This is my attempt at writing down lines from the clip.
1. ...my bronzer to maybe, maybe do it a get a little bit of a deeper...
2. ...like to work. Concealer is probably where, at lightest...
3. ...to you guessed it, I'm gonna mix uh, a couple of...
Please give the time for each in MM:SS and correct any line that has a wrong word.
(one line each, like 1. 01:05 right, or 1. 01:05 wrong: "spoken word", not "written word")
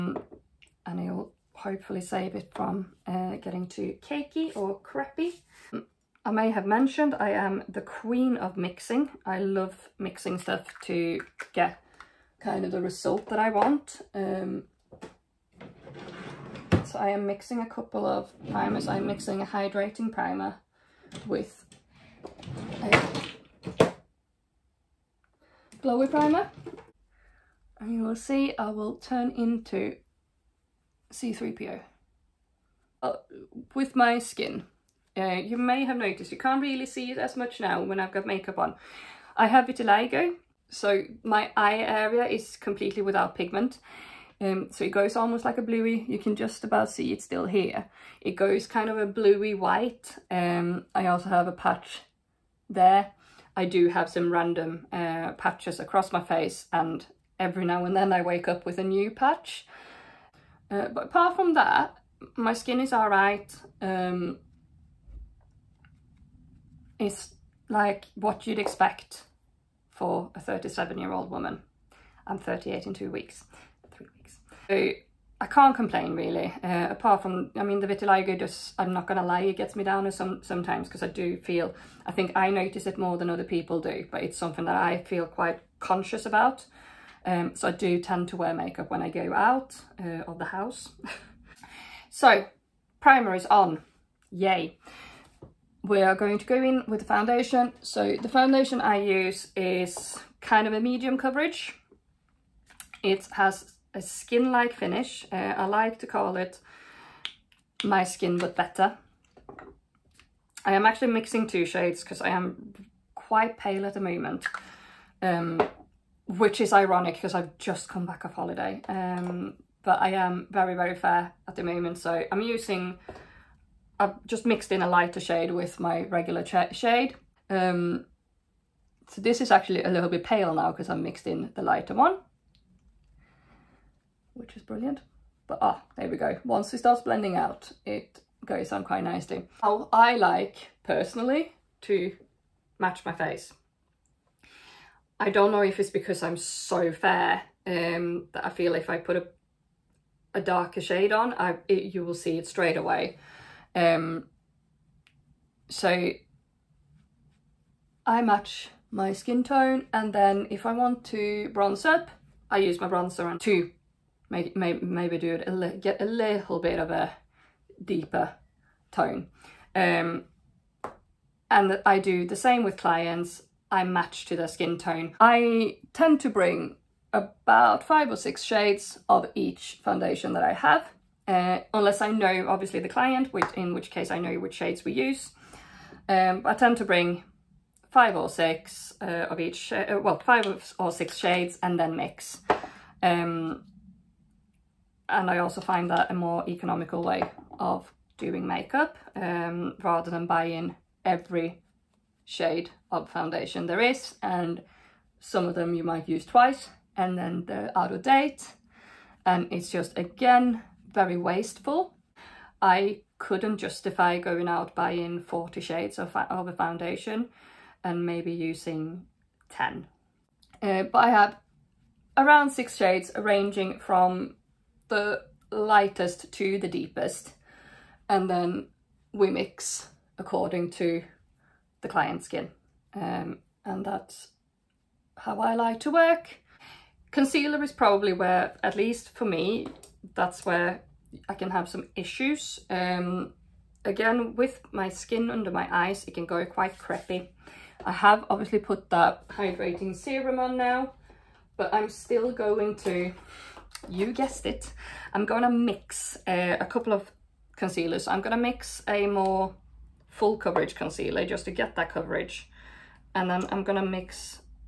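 1. 02:42 right
2. 03:55 wrong: "least", not "lightest"
3. 04:12 right.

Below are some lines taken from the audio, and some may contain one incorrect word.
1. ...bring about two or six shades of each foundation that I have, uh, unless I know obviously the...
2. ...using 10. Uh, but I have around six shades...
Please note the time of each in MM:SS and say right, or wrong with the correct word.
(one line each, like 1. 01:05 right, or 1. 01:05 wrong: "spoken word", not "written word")
1. 02:56 wrong: "five", not "two"
2. 03:38 right.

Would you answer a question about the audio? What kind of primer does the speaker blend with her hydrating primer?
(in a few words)
glowy primer.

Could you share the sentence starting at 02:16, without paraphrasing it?
Once it starts blending out, it goes on quite nicely.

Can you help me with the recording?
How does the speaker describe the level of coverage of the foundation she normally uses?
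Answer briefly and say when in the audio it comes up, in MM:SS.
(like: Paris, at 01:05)
medium coverage, at 01:40.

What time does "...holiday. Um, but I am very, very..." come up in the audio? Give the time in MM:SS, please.
01:58.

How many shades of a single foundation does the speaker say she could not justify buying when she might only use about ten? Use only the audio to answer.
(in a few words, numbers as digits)
40.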